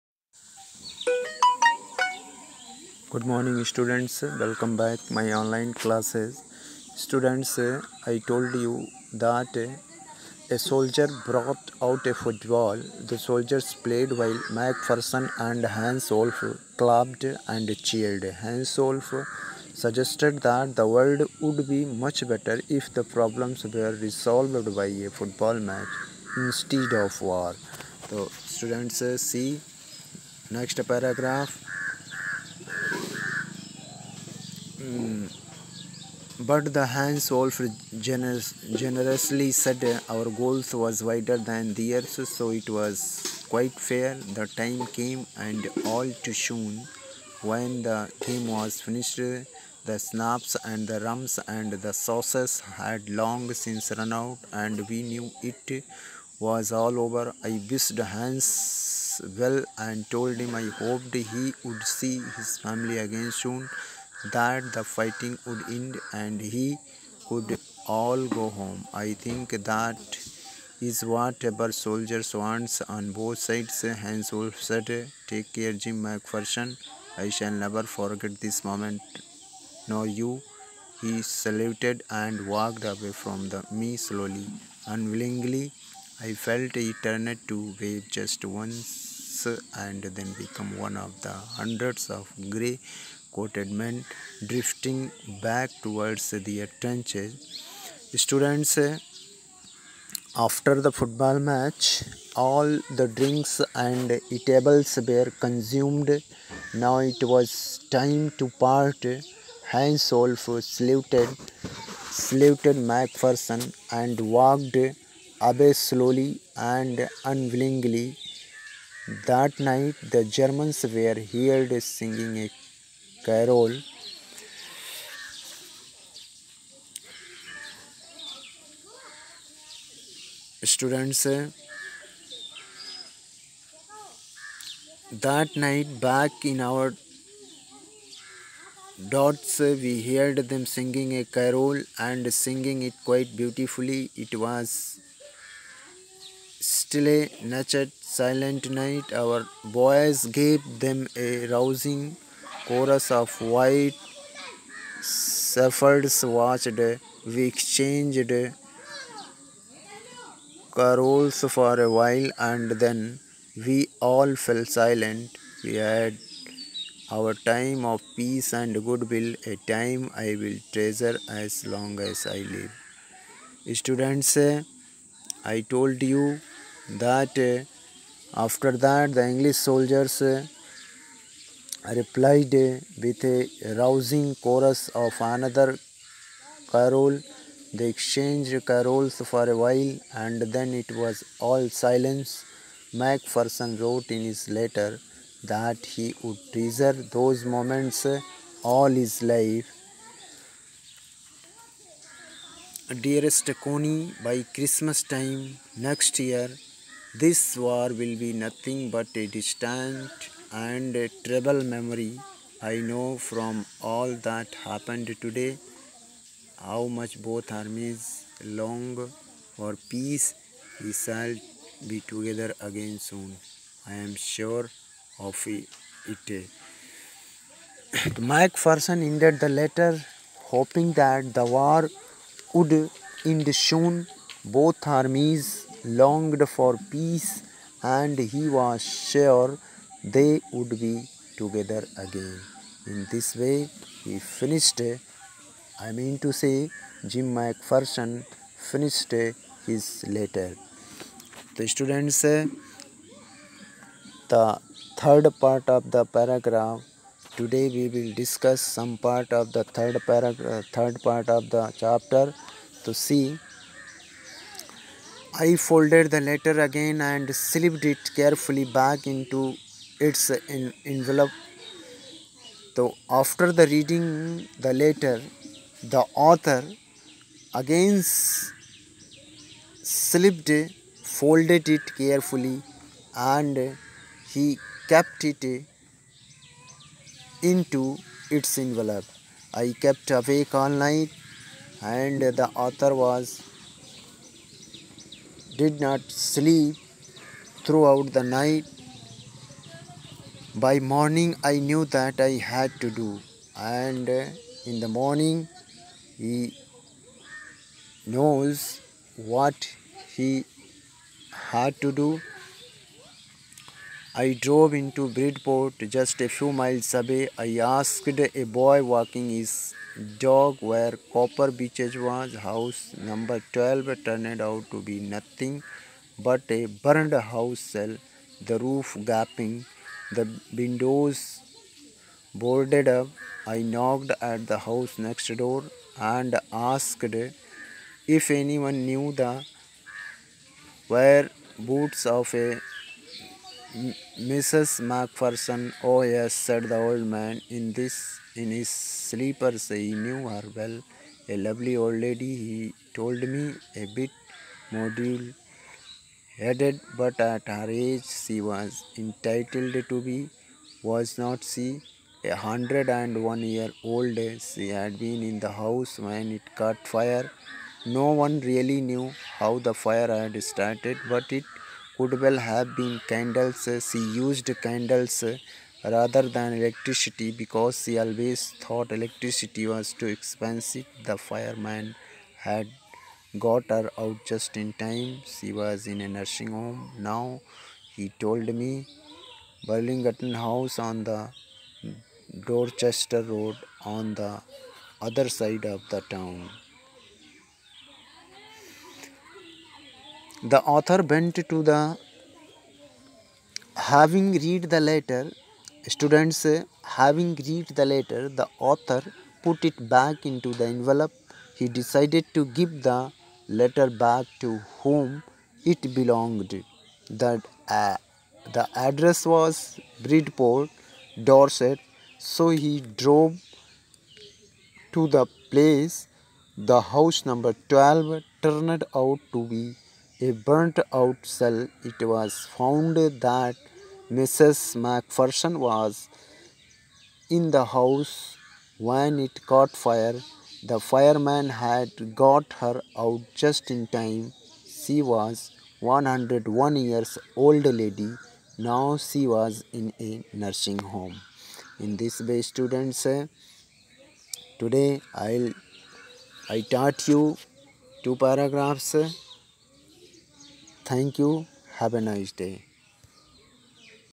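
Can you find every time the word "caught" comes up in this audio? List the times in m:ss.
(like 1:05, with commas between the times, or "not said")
6:06, 7:19.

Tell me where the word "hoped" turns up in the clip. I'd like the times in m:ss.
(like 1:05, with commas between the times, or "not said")
1:00.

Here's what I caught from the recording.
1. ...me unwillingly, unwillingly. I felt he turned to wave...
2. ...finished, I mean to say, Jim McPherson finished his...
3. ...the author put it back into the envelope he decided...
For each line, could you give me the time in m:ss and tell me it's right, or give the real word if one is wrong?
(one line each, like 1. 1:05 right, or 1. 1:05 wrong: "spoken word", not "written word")
1. 1:23 wrong: "slowly", not "unwillingly"
2. 4:04 right
3. 6:48 right.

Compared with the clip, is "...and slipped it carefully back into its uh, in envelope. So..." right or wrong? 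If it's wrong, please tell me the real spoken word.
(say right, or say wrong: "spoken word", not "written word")
right.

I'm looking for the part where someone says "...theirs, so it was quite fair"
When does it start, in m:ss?
0:41.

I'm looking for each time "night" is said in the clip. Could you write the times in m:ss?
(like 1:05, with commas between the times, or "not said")
1:59, 2:15, 2:28, 4:50, 4:58.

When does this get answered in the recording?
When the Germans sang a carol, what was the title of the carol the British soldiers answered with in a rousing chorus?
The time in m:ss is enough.
2:33.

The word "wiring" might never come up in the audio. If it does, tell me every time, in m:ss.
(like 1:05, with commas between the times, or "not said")
not said.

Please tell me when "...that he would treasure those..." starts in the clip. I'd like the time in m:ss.
3:15.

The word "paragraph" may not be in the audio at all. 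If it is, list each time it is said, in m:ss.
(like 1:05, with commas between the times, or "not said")
0:30, 4:16, 4:20, 7:38.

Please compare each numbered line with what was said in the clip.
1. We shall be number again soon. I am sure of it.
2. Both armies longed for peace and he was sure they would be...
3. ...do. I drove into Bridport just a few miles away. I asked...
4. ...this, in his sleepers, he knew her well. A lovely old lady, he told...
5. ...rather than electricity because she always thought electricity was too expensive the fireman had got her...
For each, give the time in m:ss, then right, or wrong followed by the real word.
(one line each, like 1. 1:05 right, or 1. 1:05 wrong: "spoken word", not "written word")
1. 3:40 wrong: "together", not "number"
2. 3:54 right
3. 5:11 right
4. 5:47 right
5. 6:15 right.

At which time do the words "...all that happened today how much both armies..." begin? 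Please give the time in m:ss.
3:33.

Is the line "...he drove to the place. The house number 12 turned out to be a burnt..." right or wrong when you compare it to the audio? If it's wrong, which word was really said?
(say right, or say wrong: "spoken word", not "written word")
right.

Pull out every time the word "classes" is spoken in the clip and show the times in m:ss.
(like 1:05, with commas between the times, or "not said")
0:05.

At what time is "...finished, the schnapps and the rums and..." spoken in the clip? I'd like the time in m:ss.
0:48.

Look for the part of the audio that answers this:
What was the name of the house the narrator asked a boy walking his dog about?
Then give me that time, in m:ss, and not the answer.
5:21.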